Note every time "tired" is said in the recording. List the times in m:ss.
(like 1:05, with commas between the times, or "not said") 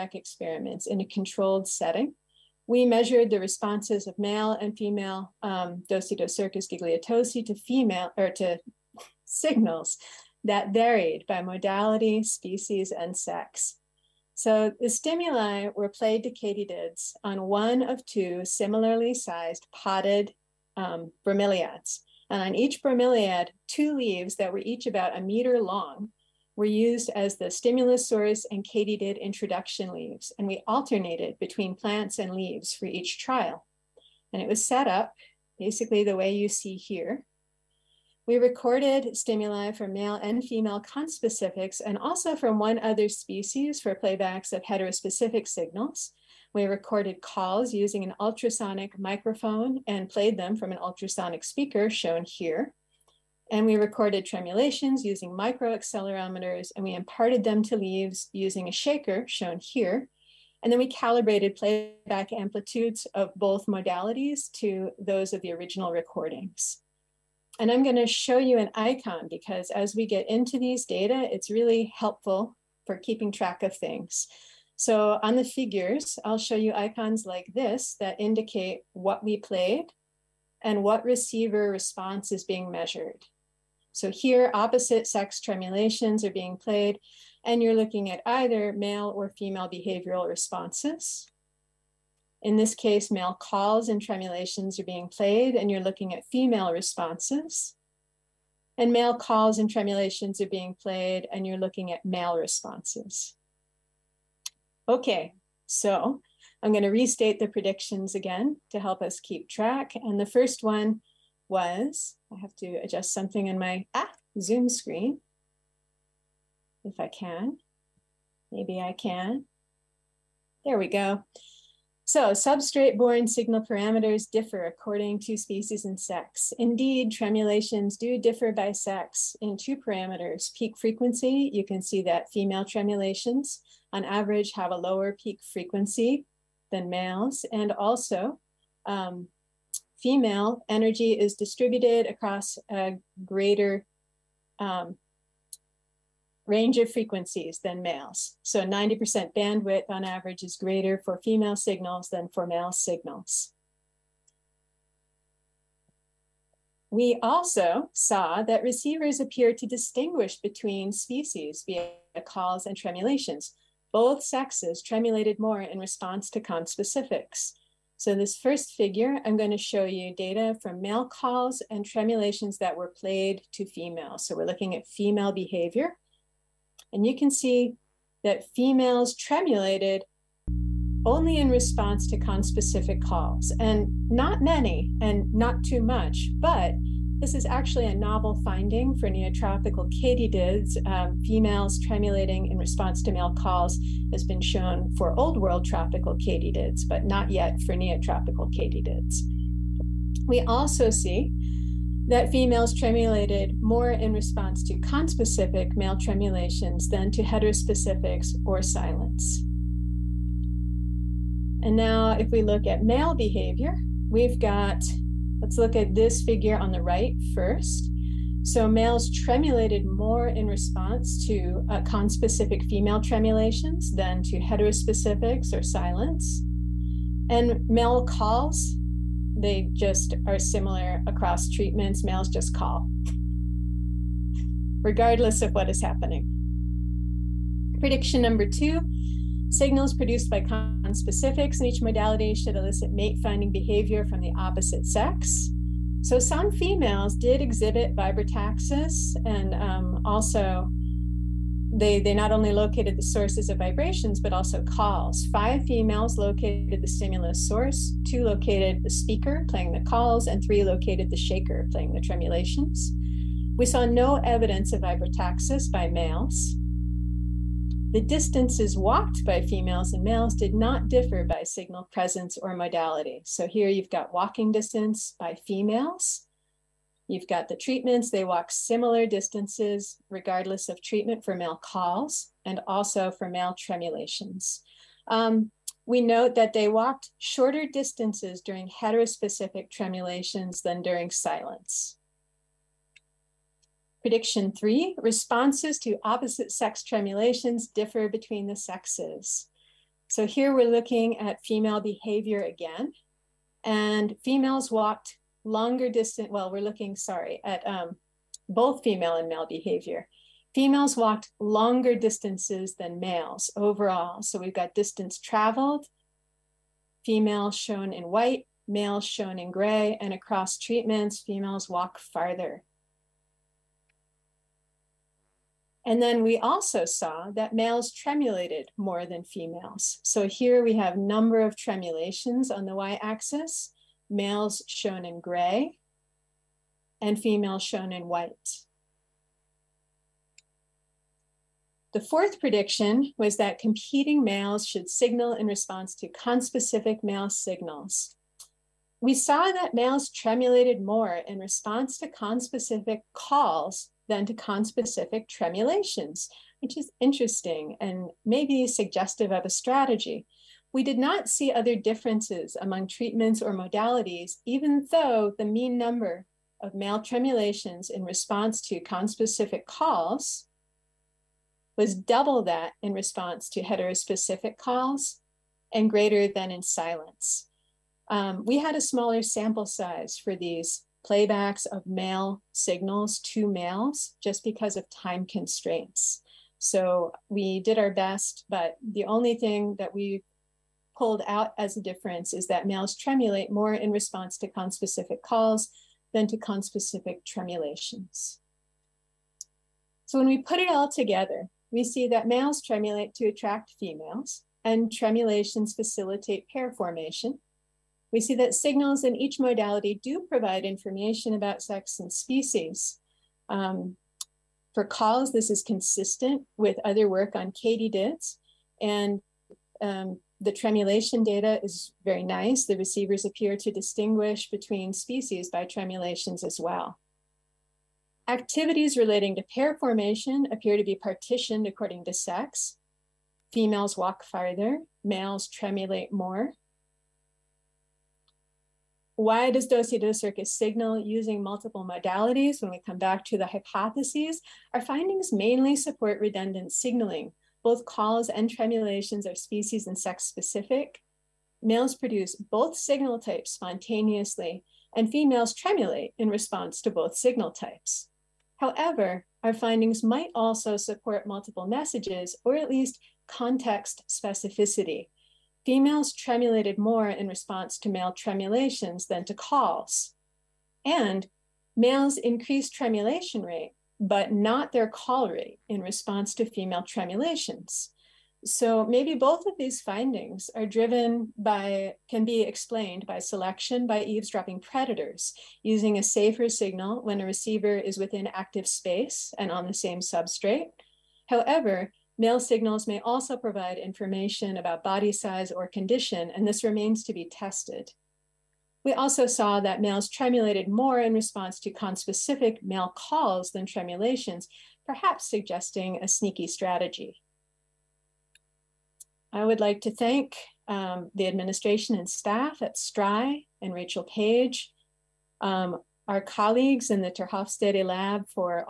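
not said.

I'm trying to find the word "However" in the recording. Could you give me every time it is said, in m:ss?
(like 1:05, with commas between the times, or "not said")
7:38, 8:11.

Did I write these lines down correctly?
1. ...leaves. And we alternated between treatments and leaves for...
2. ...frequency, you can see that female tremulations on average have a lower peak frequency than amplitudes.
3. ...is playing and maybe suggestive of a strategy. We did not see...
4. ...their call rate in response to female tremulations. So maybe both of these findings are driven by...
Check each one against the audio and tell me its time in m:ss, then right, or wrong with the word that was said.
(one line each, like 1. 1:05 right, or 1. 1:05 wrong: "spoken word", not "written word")
1. 0:29 wrong: "plants", not "treatments"
2. 2:10 wrong: "males", not "amplitudes"
3. 5:56 wrong: "interesting", not "playing"
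4. 7:54 right.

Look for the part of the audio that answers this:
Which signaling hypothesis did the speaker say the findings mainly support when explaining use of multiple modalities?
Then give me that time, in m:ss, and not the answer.
7:26.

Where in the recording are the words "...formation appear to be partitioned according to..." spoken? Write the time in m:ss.
7:09.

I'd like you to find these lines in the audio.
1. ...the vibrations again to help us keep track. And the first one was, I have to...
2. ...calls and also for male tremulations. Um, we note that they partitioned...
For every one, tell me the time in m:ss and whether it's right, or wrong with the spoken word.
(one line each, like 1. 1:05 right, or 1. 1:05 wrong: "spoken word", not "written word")
1. 1:47 wrong: "predictions", not "vibrations"
2. 4:41 wrong: "walked", not "partitioned".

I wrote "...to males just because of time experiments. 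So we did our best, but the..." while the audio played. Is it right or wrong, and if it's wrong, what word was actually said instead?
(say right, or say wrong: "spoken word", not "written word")
wrong: "constraints", not "experiments".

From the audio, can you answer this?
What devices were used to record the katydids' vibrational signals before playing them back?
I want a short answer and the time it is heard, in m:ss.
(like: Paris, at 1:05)
microaccelerometers, at 0:55.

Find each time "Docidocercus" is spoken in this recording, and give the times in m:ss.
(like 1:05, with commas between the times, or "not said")
0:05, 7:19.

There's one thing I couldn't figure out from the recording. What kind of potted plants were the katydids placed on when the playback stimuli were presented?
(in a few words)
bromeliads.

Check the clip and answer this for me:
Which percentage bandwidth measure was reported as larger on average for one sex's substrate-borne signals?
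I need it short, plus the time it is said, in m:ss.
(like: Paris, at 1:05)
90%, at 2:28.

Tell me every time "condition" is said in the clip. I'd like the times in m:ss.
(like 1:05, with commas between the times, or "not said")
8:15.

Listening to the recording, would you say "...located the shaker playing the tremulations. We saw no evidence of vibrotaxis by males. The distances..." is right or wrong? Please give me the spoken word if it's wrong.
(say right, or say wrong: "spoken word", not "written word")
right.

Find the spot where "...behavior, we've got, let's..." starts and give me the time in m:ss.
3:33.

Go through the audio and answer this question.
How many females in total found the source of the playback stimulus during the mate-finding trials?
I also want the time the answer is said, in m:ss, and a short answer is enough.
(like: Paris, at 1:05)
5, at 4:15.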